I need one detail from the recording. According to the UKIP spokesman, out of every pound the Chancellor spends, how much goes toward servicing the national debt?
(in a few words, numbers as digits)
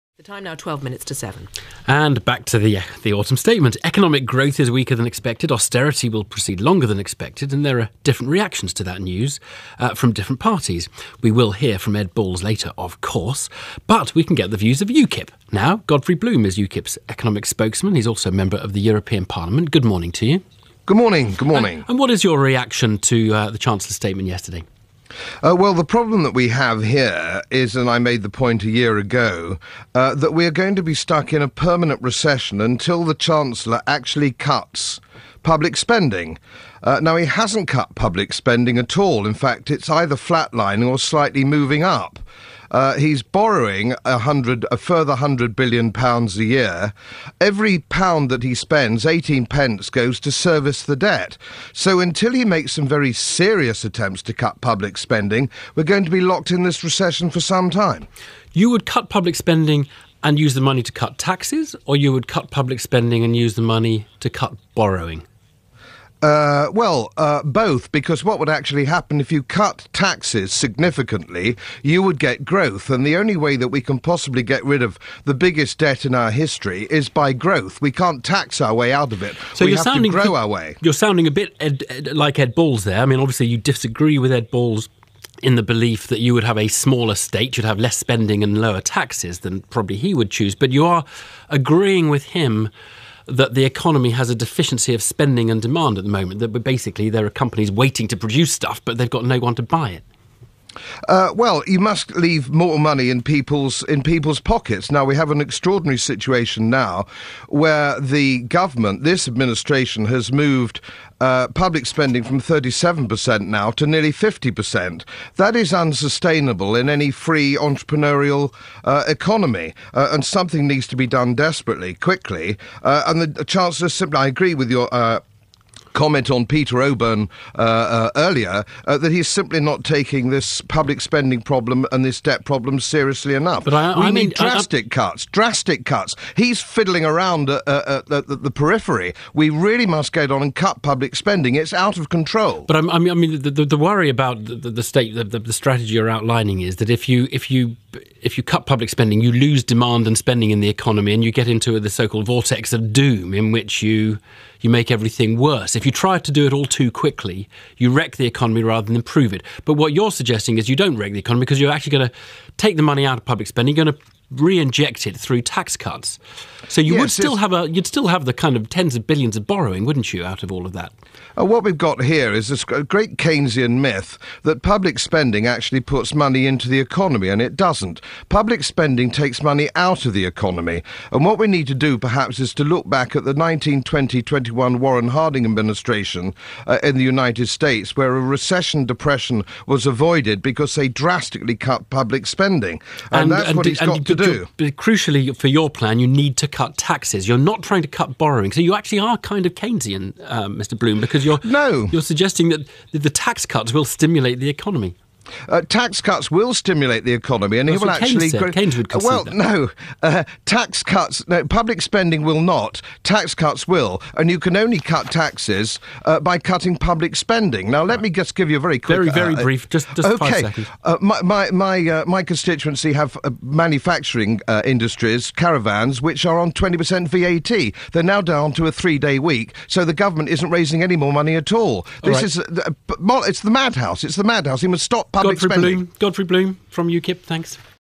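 18p.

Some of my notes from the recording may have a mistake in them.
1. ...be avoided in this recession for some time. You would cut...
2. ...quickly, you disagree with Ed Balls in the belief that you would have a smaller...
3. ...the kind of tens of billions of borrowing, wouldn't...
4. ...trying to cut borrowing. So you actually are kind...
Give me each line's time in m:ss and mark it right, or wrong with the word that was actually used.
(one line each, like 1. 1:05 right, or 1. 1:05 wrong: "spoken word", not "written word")
1. 0:56 wrong: "locked", not "avoided"
2. 1:23 wrong: "obviously", not "quickly"
3. 2:48 right
4. 3:17 right.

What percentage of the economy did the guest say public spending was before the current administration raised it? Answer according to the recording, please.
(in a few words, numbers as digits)
37%.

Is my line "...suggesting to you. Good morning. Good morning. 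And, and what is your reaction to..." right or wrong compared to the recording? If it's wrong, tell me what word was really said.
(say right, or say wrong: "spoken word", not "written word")
wrong: "morning", not "suggesting".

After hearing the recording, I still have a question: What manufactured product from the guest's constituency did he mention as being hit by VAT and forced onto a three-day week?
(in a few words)
Caravans.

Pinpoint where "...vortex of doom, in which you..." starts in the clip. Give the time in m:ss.
2:32.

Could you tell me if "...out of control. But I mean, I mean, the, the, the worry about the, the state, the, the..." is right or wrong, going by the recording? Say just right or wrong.
right.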